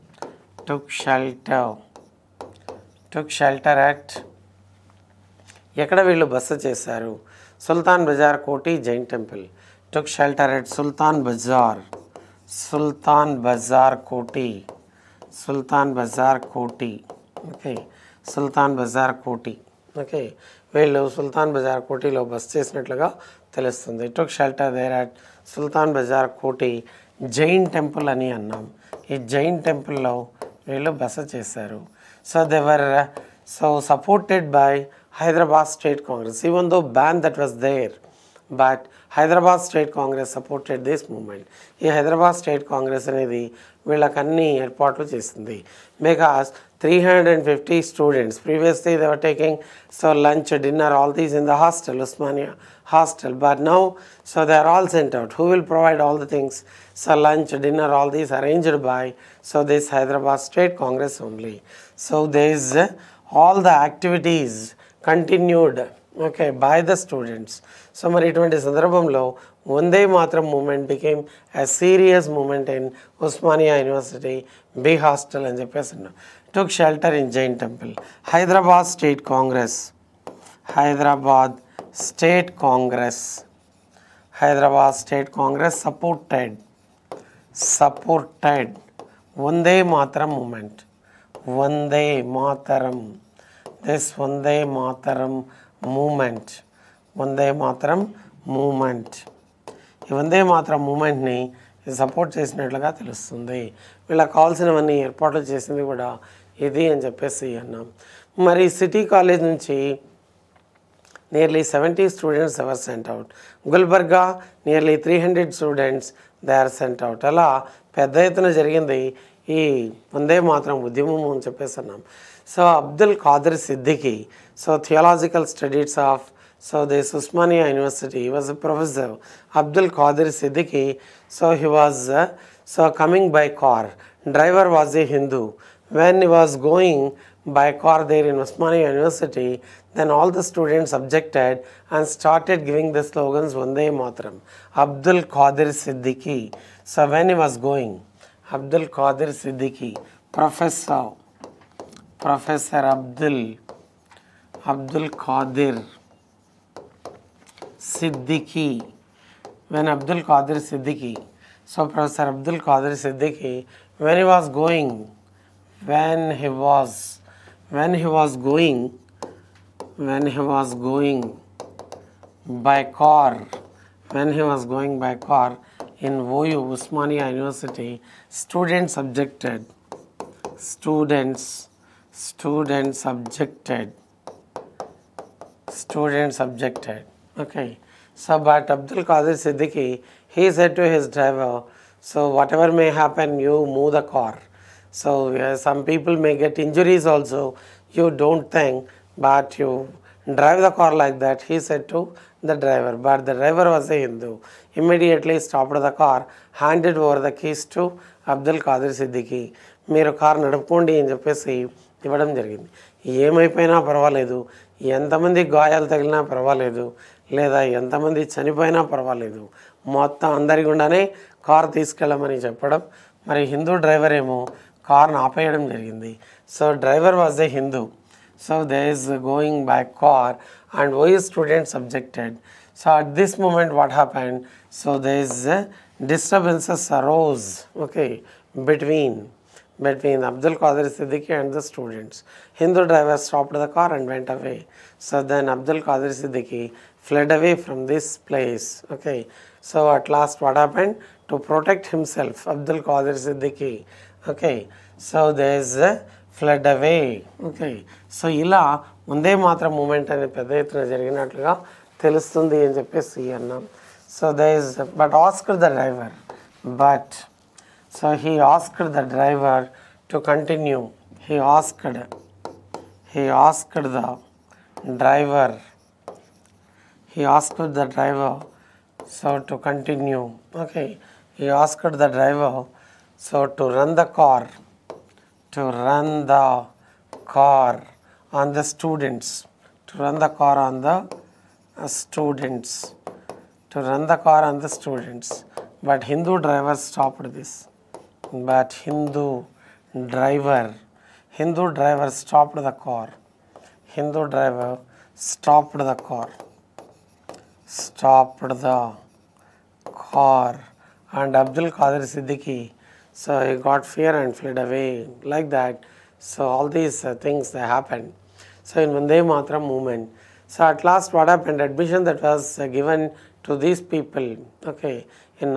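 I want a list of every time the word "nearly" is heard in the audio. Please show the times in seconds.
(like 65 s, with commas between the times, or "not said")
not said.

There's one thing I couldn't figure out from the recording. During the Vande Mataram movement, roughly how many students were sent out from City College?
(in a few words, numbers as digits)
70.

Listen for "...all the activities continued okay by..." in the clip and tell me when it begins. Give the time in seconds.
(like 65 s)
63 s.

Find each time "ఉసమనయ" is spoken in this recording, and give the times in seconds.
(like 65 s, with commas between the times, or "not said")
73 s, 127 s.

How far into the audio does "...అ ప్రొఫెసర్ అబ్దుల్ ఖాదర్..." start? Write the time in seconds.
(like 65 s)
128 s.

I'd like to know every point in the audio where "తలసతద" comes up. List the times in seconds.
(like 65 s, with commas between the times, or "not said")
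23 s, 102 s.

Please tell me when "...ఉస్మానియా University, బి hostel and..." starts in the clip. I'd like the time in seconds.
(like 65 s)
73 s.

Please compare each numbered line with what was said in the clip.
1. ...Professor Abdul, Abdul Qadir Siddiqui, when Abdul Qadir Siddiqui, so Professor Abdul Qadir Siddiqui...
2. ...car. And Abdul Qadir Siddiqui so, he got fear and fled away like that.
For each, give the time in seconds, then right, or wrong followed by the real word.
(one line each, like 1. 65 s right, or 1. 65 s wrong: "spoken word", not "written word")
1. 152 s right
2. 310 s right.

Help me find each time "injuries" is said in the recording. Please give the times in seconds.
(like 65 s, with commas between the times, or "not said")
196 s.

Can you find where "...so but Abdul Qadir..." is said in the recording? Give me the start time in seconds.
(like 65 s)
188 s.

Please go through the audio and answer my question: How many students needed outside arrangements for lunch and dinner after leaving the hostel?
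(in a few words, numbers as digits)
350.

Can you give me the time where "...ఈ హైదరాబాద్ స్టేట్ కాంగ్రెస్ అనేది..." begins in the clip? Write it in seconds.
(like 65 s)
41 s.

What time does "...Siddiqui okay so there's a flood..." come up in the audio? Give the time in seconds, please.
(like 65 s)
253 s.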